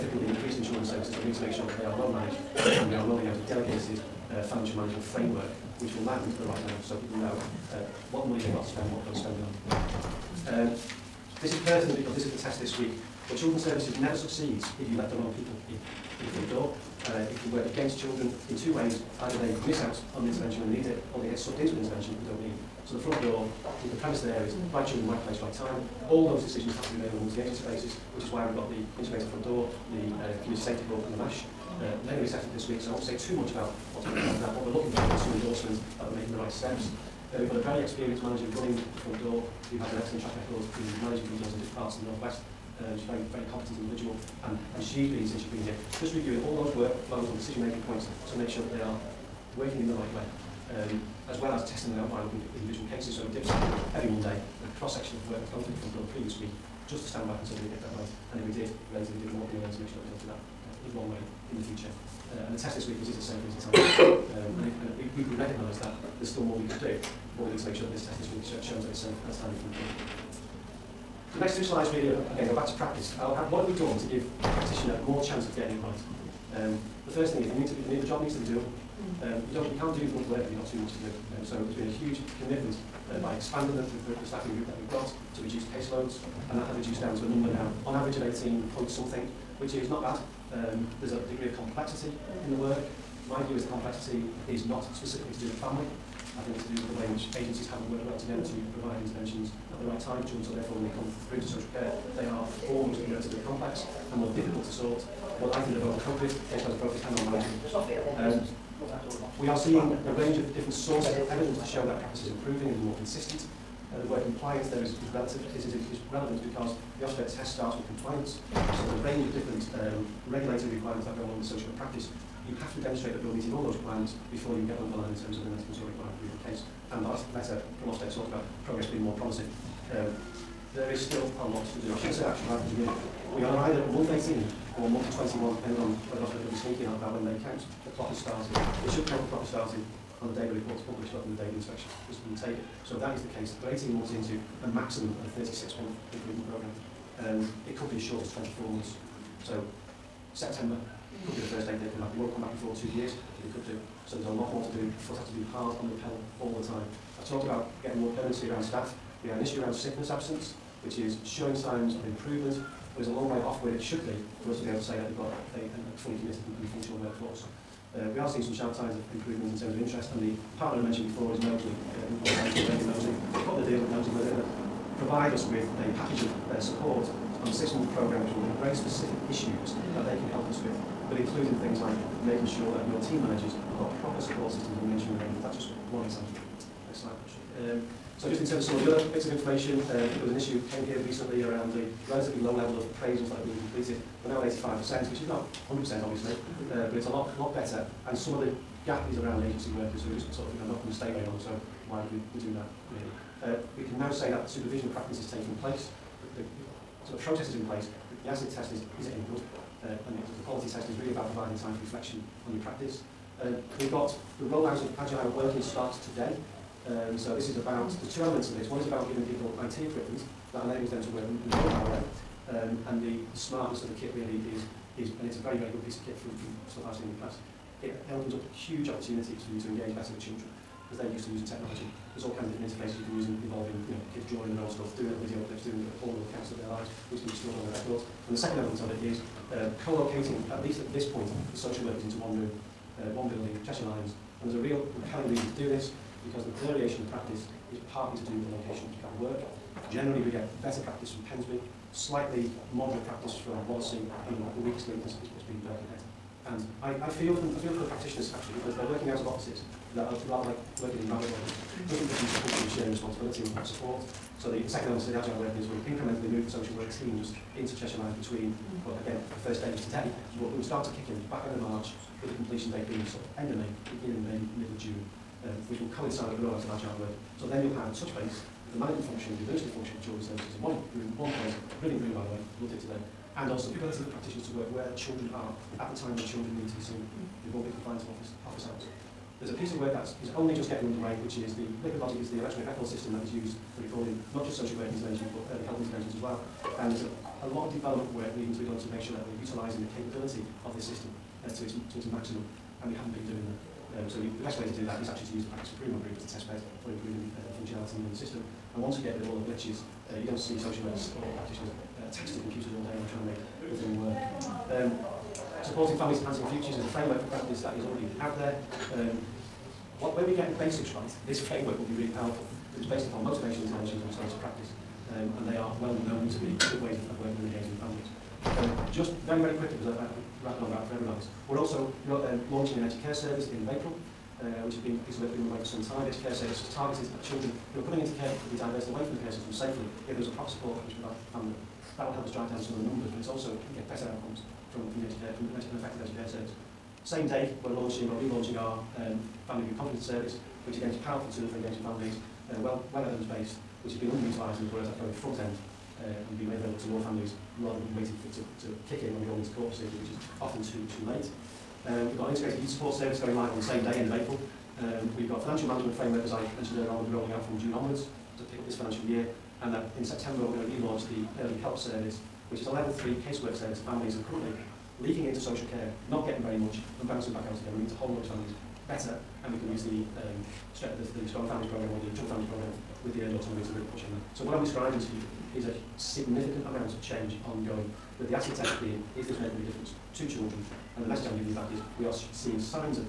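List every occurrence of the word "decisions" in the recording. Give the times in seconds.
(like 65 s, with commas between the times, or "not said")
26 s, 47 s.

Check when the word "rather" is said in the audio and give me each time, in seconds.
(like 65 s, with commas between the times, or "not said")
141 s, 260 s, 357 s.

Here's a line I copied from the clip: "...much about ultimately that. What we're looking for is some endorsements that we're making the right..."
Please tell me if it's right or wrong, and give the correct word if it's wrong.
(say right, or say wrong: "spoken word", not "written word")
right.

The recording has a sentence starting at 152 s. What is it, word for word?
They won't come back before two years, they could do.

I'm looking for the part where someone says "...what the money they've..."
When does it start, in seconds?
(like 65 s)
8 s.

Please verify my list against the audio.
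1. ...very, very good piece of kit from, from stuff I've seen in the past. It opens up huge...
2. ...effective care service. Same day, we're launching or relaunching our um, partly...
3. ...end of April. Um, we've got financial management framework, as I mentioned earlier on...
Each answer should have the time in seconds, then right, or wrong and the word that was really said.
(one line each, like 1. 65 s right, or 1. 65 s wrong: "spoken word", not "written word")
1. 225 s right
2. 345 s wrong: "family", not "partly"
3. 363 s right.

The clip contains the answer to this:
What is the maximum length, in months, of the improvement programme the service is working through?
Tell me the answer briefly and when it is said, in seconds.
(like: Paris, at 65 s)
36 months, at 145 s.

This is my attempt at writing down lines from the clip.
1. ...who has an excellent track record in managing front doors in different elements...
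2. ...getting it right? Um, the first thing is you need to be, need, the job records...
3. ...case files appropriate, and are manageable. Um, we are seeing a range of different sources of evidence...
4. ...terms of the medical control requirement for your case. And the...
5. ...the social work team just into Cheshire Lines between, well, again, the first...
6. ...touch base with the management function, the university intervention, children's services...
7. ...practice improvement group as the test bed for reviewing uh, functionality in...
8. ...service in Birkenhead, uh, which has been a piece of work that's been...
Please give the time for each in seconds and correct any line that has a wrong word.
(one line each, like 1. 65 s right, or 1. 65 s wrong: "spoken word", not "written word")
1. 39 s wrong: "parts", not "elements"
2. 75 s wrong: "needs", not "records"
3. 106 s right
4. 125 s right
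5. 266 s right
6. 277 s wrong: "function", not "intervention"
7. 305 s wrong: "improving", not "reviewing"
8. 333 s wrong: "April", not "Birkenhead".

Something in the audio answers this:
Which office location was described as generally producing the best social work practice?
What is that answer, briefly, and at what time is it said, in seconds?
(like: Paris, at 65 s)
Pensby, at 251 s.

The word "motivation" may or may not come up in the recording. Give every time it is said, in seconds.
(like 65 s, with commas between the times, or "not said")
323 s.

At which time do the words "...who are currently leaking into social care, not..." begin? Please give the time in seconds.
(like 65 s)
374 s.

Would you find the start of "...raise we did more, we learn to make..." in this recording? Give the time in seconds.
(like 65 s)
58 s.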